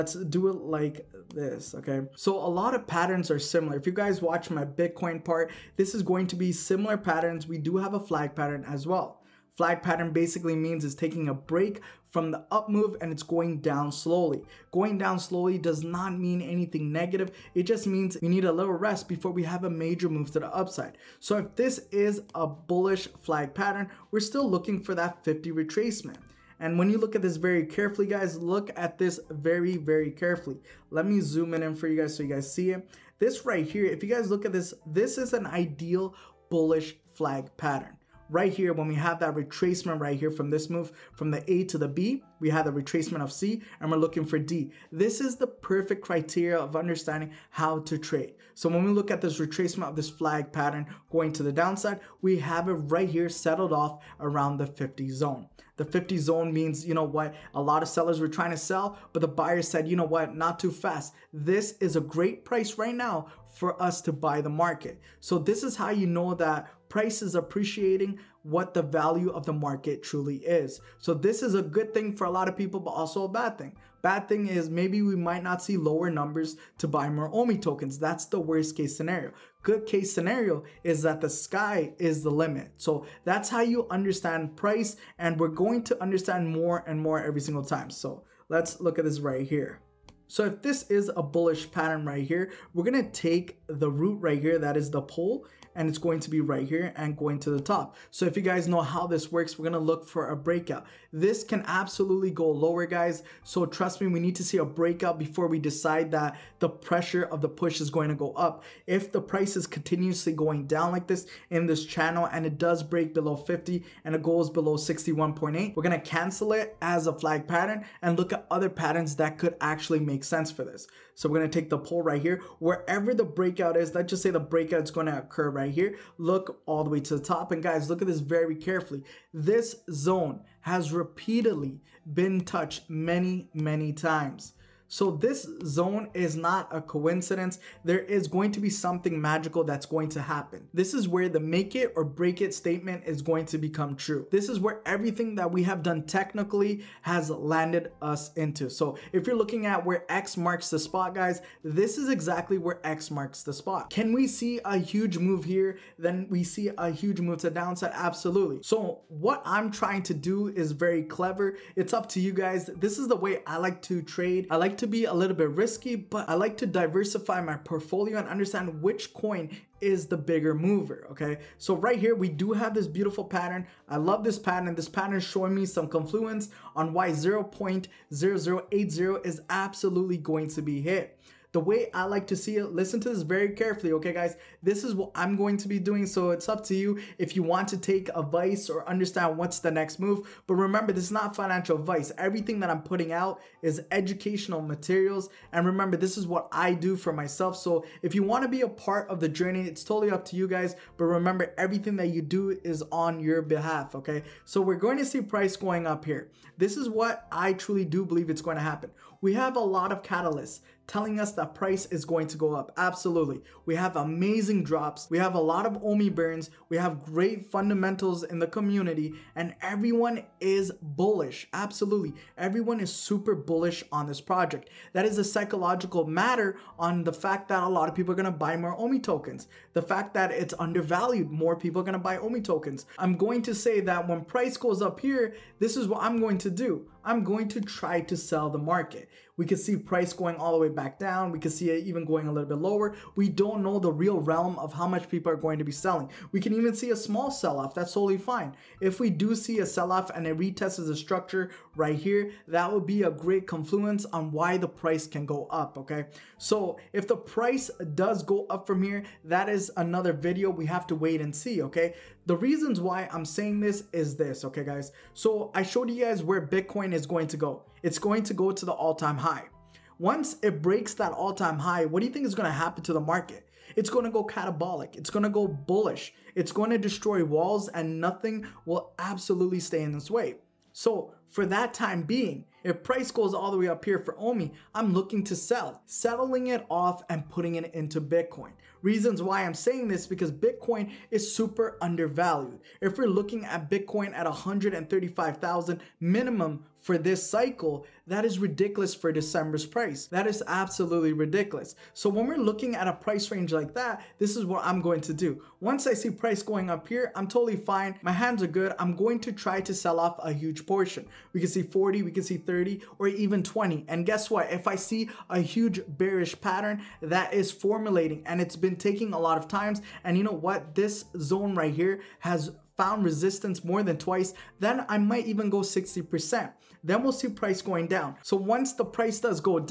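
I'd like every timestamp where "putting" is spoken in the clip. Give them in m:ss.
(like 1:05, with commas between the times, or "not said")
3:12, 4:47.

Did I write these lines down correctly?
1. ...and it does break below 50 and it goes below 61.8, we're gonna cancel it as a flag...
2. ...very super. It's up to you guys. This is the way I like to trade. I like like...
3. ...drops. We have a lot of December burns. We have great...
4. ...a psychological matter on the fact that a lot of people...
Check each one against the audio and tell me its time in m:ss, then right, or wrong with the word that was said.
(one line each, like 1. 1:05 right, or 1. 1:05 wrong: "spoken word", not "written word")
1. 1:52 right
2. 2:40 wrong: "clever", not "super"
3. 3:34 wrong: "Omi", not "December"
4. 3:45 right.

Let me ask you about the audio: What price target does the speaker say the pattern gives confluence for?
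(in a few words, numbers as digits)
0.0080.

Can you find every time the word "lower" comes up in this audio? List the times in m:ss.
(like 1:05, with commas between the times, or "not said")
1:15, 1:42, 4:02.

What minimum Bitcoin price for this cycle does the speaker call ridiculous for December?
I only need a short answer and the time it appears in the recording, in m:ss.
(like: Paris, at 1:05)
135,000, at 4:54.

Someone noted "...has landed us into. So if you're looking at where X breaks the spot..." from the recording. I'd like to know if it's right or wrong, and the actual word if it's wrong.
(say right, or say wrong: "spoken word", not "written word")
wrong: "marks", not "breaks".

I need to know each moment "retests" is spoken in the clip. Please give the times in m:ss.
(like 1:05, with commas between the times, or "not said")
4:10.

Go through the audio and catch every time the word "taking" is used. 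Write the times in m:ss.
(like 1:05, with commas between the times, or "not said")
0:10, 5:18.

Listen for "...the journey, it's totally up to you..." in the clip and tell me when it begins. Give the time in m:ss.
3:19.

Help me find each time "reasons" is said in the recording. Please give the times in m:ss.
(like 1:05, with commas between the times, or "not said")
4:22, 4:48.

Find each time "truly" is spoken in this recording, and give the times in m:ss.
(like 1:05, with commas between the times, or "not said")
1:10, 3:27.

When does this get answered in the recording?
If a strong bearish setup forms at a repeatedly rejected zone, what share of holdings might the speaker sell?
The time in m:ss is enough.
5:25.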